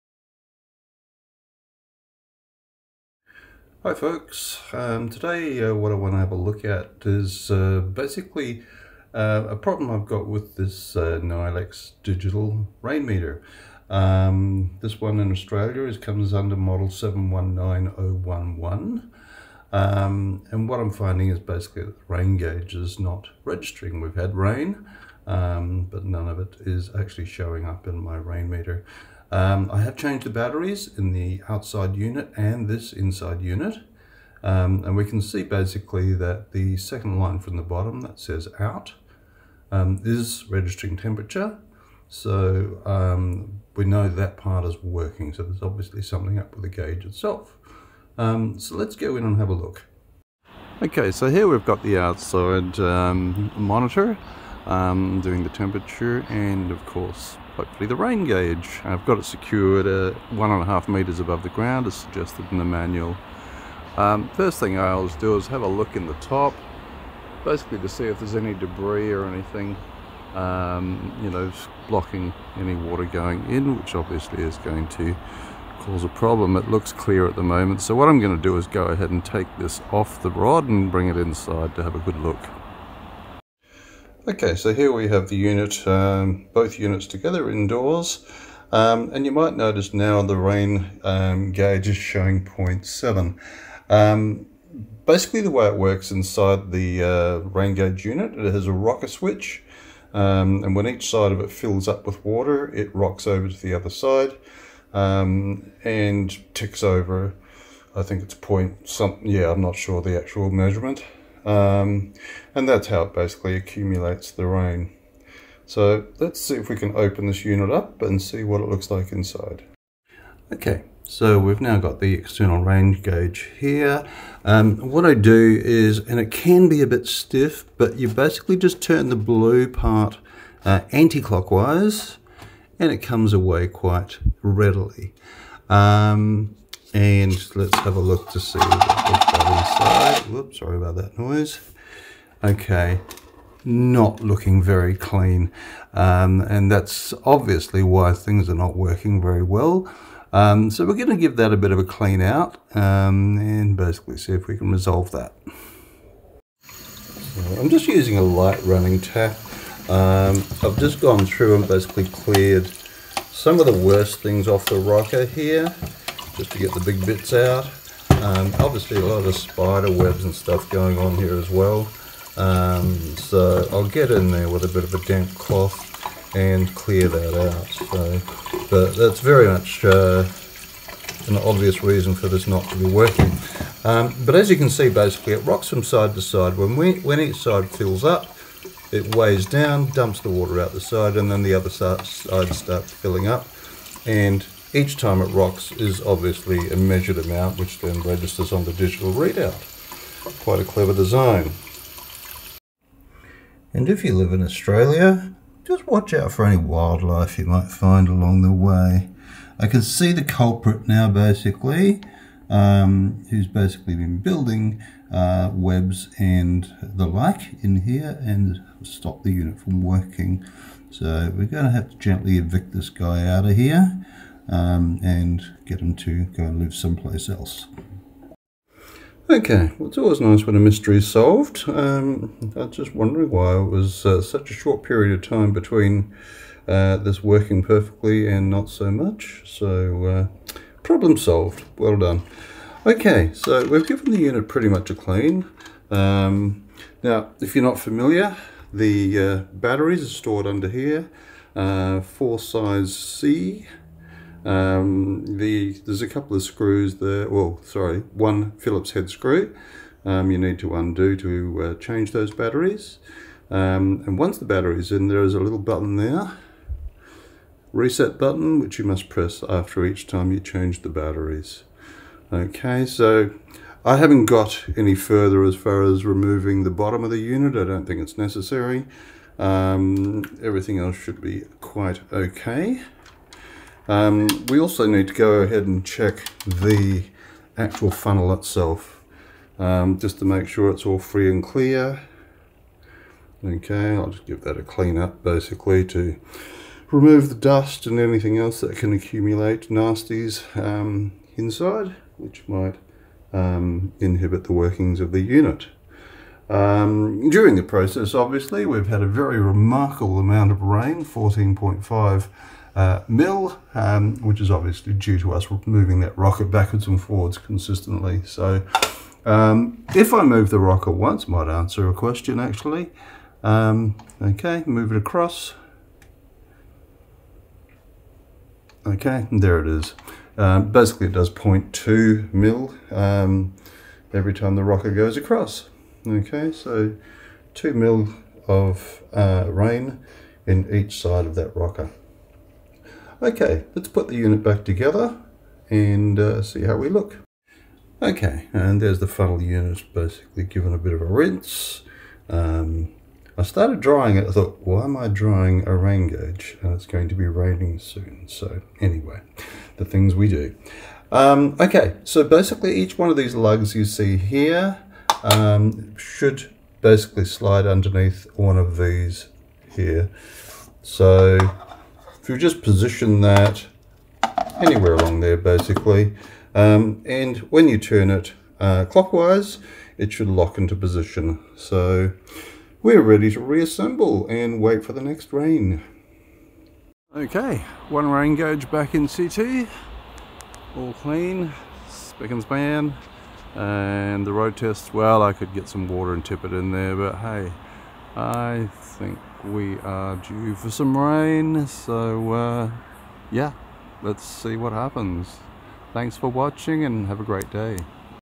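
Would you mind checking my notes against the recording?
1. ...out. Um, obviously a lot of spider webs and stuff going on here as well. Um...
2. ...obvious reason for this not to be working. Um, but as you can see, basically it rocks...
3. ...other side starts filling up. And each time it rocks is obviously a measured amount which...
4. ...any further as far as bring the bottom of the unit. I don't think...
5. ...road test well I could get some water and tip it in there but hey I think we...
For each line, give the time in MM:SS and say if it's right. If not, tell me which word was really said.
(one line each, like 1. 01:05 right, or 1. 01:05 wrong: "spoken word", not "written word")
1. 02:47 right
2. 03:01 right
3. 03:11 right
4. 04:34 wrong: "removing", not "bring"
5. 06:34 right.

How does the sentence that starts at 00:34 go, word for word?
Um, and we can see basically that the second line from the bottom that says out um, is registering temperature.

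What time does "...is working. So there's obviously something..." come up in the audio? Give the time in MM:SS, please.
00:44.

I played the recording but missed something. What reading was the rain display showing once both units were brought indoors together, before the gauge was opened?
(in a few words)
0.7.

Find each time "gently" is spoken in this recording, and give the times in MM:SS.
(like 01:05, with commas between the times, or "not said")
03:41.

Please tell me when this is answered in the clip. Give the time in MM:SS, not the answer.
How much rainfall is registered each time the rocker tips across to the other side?
05:31.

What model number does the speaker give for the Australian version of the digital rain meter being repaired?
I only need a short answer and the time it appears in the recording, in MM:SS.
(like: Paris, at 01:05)
719011, at 00:16.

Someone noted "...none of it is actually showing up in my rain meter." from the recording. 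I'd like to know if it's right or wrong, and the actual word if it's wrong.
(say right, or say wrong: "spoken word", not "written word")
right.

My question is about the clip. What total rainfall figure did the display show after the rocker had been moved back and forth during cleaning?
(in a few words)
14.5 mm.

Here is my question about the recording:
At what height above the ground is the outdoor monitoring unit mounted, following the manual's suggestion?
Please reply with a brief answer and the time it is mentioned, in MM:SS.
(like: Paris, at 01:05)
1.5 meters, at 01:00.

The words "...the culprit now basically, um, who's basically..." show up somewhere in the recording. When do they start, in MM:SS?
03:30.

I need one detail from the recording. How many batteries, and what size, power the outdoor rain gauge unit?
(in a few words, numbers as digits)
4 size C.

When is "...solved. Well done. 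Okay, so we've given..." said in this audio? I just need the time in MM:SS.
04:01.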